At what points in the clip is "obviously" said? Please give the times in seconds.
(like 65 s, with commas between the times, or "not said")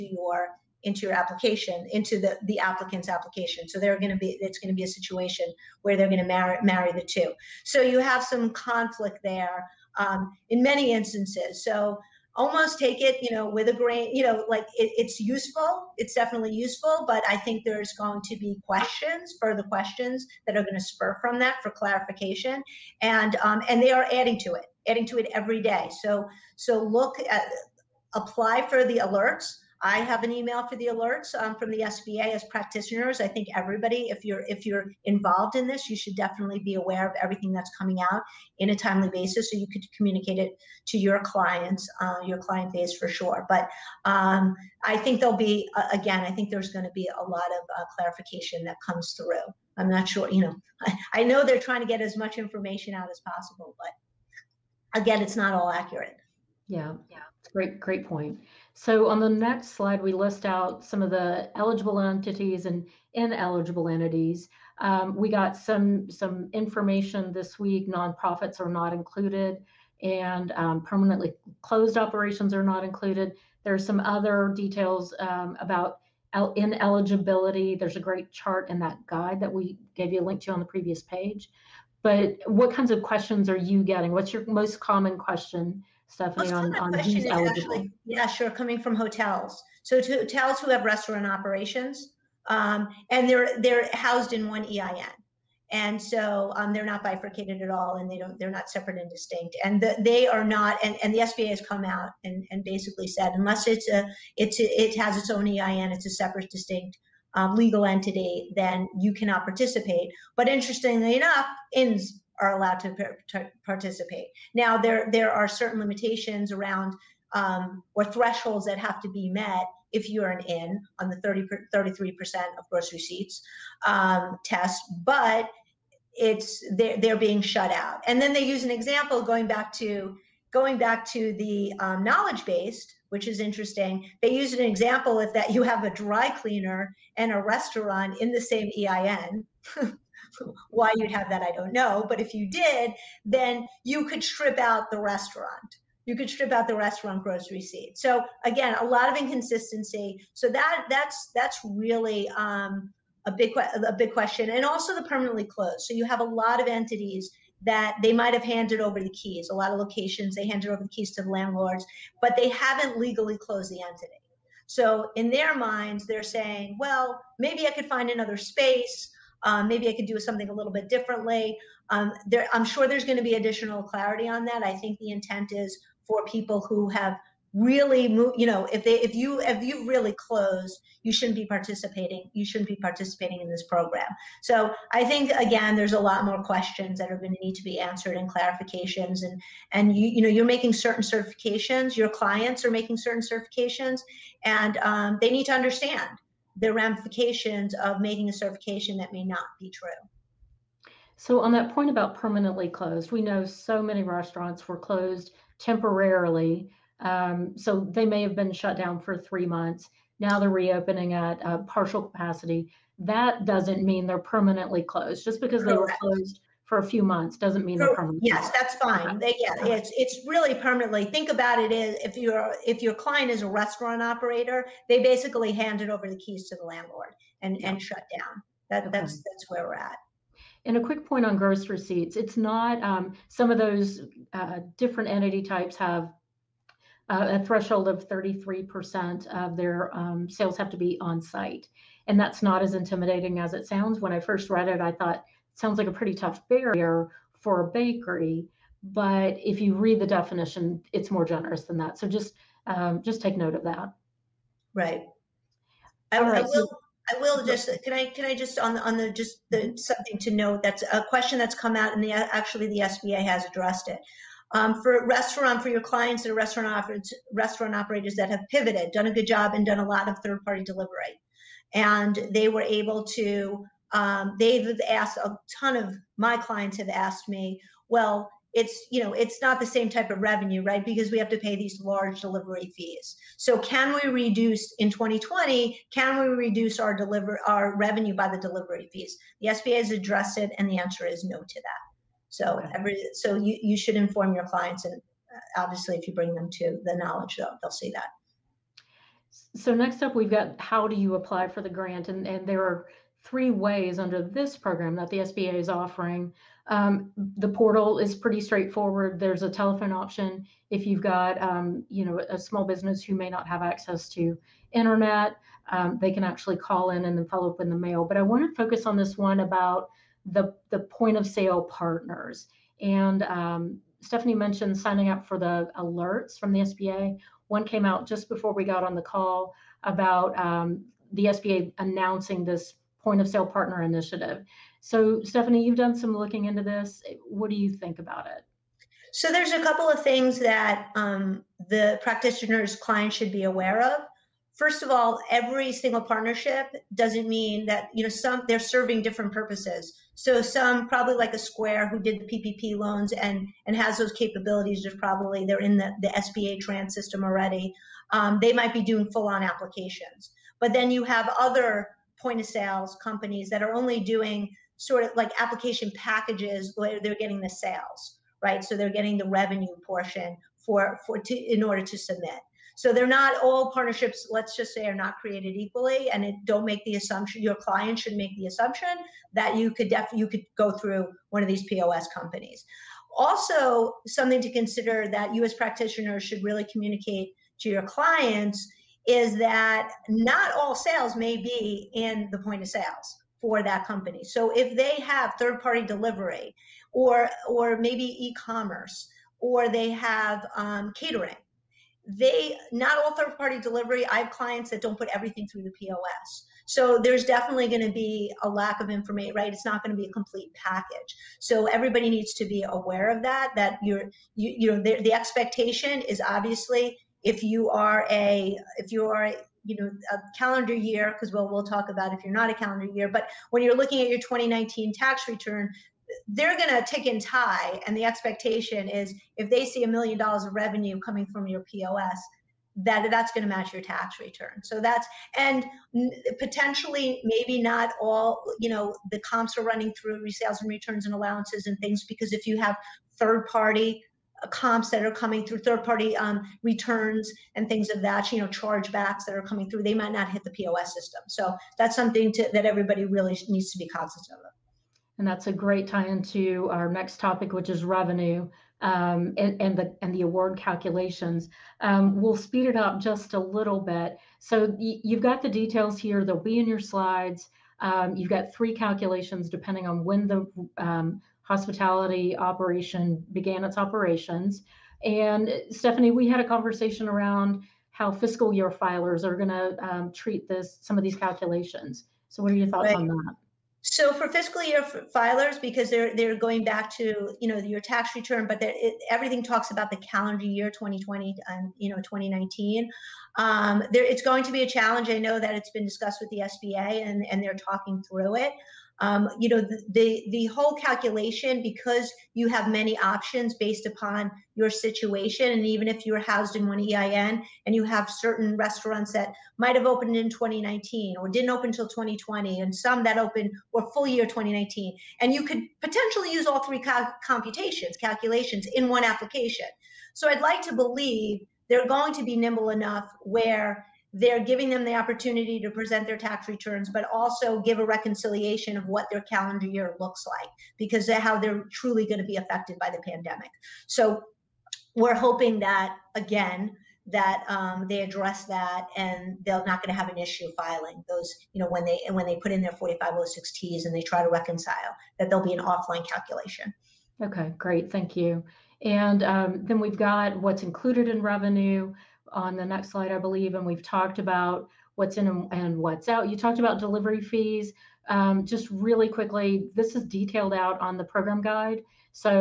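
295 s, 416 s.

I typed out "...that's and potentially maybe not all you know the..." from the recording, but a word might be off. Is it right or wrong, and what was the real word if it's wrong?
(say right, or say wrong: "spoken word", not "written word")
right.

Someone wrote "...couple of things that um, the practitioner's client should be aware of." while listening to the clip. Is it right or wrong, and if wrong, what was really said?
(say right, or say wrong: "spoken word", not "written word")
right.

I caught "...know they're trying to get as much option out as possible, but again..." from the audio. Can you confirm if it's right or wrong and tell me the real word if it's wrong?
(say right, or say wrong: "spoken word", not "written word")
wrong: "information", not "option".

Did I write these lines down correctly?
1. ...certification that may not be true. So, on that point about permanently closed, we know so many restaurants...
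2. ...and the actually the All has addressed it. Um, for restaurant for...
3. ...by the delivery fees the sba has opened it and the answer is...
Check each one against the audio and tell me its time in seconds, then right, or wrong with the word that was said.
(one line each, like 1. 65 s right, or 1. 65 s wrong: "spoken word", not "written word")
1. 198 s right
2. 261 s wrong: "SBA", not "All"
3. 288 s wrong: "addressed", not "opened".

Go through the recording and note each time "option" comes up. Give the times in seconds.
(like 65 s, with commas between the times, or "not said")
309 s, 502 s.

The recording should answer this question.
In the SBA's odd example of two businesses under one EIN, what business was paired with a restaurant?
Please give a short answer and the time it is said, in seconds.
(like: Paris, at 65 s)
A dry cleaner, at 135 s.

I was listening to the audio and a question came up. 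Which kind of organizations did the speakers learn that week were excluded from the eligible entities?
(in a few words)
Nonprofits.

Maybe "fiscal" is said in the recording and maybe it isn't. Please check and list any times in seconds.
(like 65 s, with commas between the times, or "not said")
478 s, 484 s.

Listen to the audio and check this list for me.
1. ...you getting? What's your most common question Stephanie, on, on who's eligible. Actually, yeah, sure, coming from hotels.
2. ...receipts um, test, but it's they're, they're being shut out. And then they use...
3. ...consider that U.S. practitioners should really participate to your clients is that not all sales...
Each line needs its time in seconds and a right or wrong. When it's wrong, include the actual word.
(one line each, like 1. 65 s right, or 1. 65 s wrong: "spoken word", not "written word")
1. 83 s right
2. 122 s right
3. 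384 s wrong: "communicate", not "participate".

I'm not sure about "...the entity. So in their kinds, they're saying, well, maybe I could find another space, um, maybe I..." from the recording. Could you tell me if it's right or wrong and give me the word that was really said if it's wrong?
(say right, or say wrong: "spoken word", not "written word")
wrong: "minds", not "kinds".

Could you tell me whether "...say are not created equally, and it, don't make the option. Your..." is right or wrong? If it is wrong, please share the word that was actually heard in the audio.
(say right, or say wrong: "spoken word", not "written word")
wrong: "assumption", not "option".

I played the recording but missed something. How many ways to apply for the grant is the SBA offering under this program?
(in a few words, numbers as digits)
3.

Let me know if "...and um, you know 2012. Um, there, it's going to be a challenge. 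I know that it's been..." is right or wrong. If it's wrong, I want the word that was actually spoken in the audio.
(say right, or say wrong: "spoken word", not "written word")
wrong: "2019", not "2012".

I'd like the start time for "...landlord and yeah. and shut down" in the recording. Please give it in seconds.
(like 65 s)
226 s.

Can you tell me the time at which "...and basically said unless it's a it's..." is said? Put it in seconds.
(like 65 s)
102 s.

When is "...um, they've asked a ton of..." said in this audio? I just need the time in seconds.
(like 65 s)
273 s.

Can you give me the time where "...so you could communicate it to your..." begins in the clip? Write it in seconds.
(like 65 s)
39 s.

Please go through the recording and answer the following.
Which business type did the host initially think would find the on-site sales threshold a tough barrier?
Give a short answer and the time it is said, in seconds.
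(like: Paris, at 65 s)
A bakery, at 247 s.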